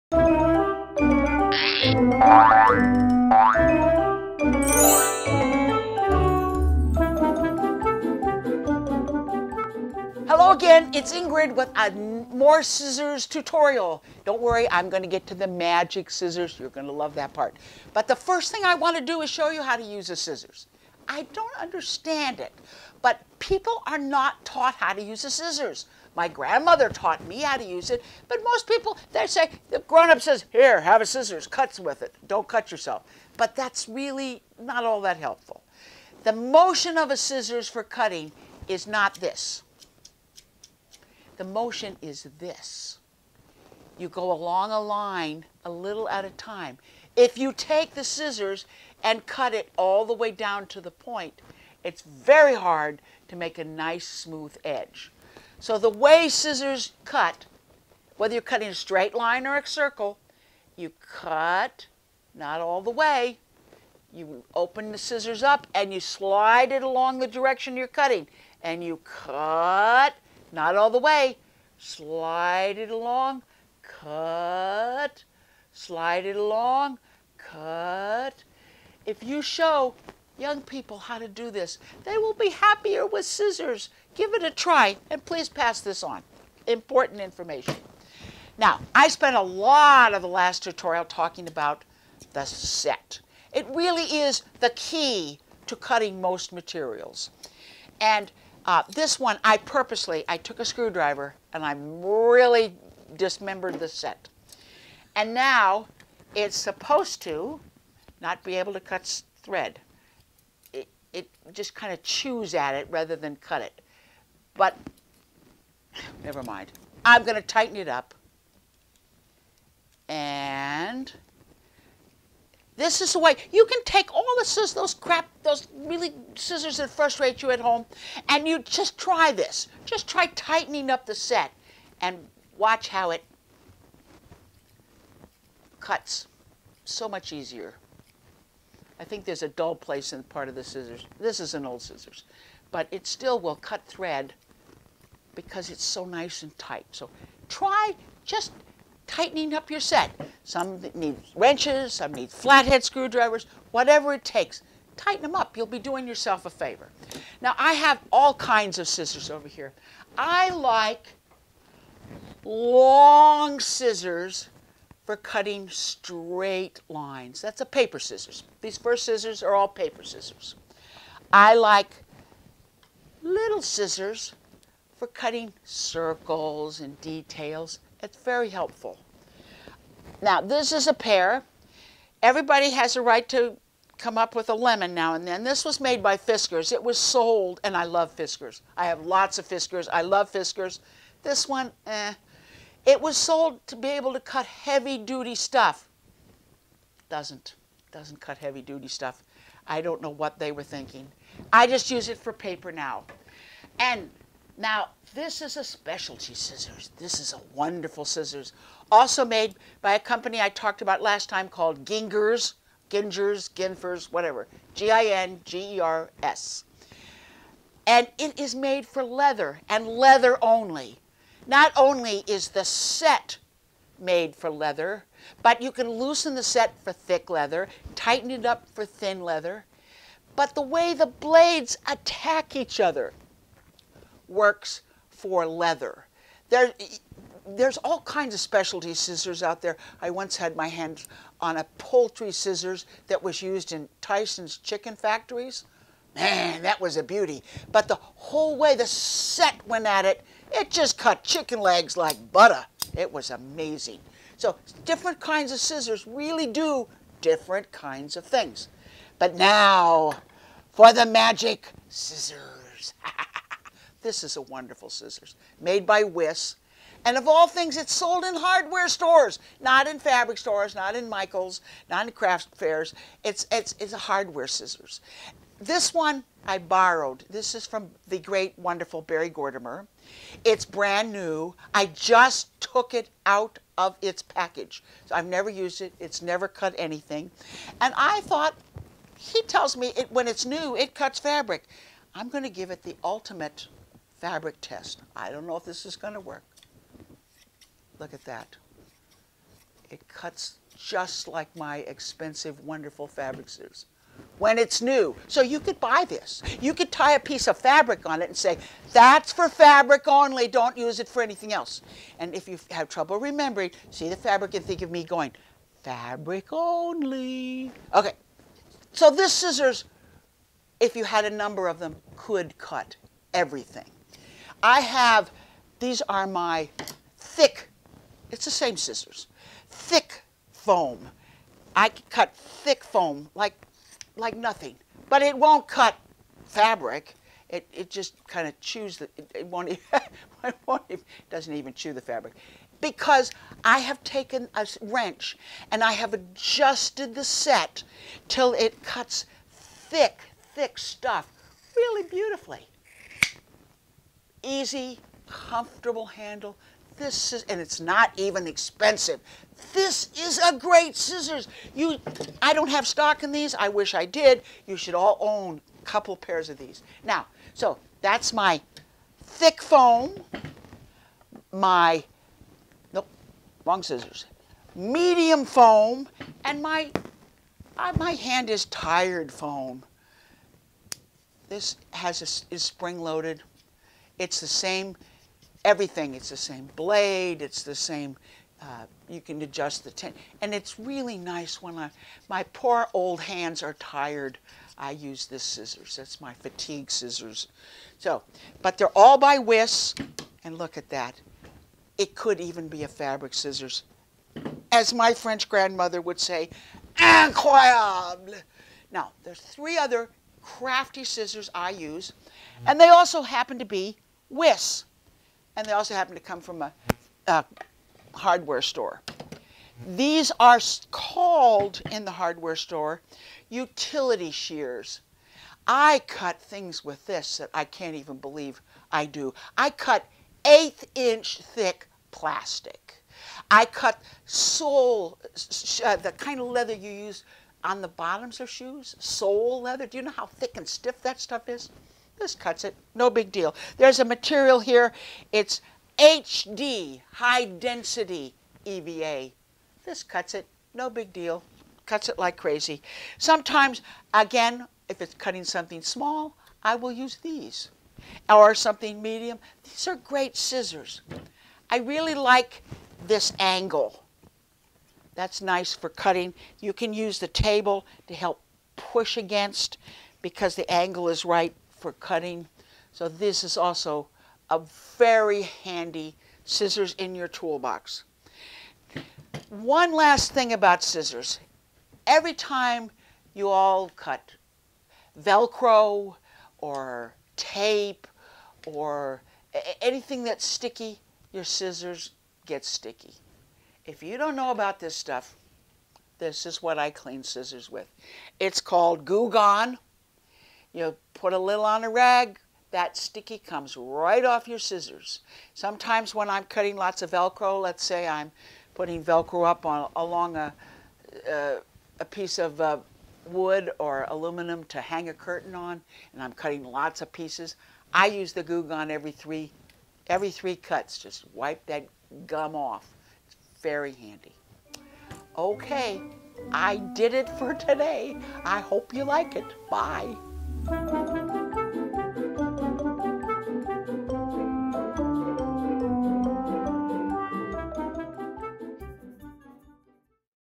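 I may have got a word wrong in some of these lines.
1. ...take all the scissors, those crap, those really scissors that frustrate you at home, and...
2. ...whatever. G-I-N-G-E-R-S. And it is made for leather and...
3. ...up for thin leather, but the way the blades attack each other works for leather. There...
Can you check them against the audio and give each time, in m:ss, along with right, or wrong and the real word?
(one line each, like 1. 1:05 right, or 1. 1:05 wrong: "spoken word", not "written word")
1. 2:03 right
2. 3:34 right
3. 3:48 right.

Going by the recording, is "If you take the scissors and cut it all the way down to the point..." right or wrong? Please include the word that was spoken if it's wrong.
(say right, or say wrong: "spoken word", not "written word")
right.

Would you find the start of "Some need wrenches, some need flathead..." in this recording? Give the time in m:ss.
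2:30.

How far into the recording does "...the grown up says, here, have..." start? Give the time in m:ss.
0:29.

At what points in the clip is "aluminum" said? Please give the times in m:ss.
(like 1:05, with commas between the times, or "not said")
8:34.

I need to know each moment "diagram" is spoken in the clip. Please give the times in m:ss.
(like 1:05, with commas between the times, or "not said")
not said.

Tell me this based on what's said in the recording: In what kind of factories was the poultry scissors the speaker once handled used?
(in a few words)
Tyson's chicken factories.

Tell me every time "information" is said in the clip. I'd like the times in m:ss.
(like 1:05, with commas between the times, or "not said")
1:27.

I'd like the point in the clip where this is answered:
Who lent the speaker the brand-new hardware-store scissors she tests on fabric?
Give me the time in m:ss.
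4:39.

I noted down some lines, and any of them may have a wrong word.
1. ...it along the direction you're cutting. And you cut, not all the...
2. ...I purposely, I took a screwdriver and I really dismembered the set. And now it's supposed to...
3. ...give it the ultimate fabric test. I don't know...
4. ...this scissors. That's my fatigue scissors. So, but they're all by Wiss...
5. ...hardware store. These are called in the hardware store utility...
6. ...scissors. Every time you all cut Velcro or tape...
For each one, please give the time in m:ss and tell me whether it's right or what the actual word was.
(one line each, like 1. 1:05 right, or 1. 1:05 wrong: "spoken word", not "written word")
1. 1:06 right
2. 1:39 right
3. 4:52 right
4. 6:35 right
5. 6:58 right
6. 8:00 right.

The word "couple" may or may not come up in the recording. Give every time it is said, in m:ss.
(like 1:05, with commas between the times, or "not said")
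6:05.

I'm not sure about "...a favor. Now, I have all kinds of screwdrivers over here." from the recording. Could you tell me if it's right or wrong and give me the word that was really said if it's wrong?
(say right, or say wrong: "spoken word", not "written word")
wrong: "scissors", not "screwdrivers".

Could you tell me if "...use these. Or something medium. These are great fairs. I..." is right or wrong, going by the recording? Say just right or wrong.
wrong.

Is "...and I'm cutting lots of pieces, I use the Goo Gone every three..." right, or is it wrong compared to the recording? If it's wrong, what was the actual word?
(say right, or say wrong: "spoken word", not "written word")
right.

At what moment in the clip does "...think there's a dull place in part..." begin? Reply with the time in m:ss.
2:19.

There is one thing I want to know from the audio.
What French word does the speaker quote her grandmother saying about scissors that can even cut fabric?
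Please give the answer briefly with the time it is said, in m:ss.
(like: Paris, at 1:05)
Incroyable, at 6:46.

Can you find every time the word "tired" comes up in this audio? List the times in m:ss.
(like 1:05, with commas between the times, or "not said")
6:18, 6:33.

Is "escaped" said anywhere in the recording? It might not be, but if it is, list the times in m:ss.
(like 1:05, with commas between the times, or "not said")
not said.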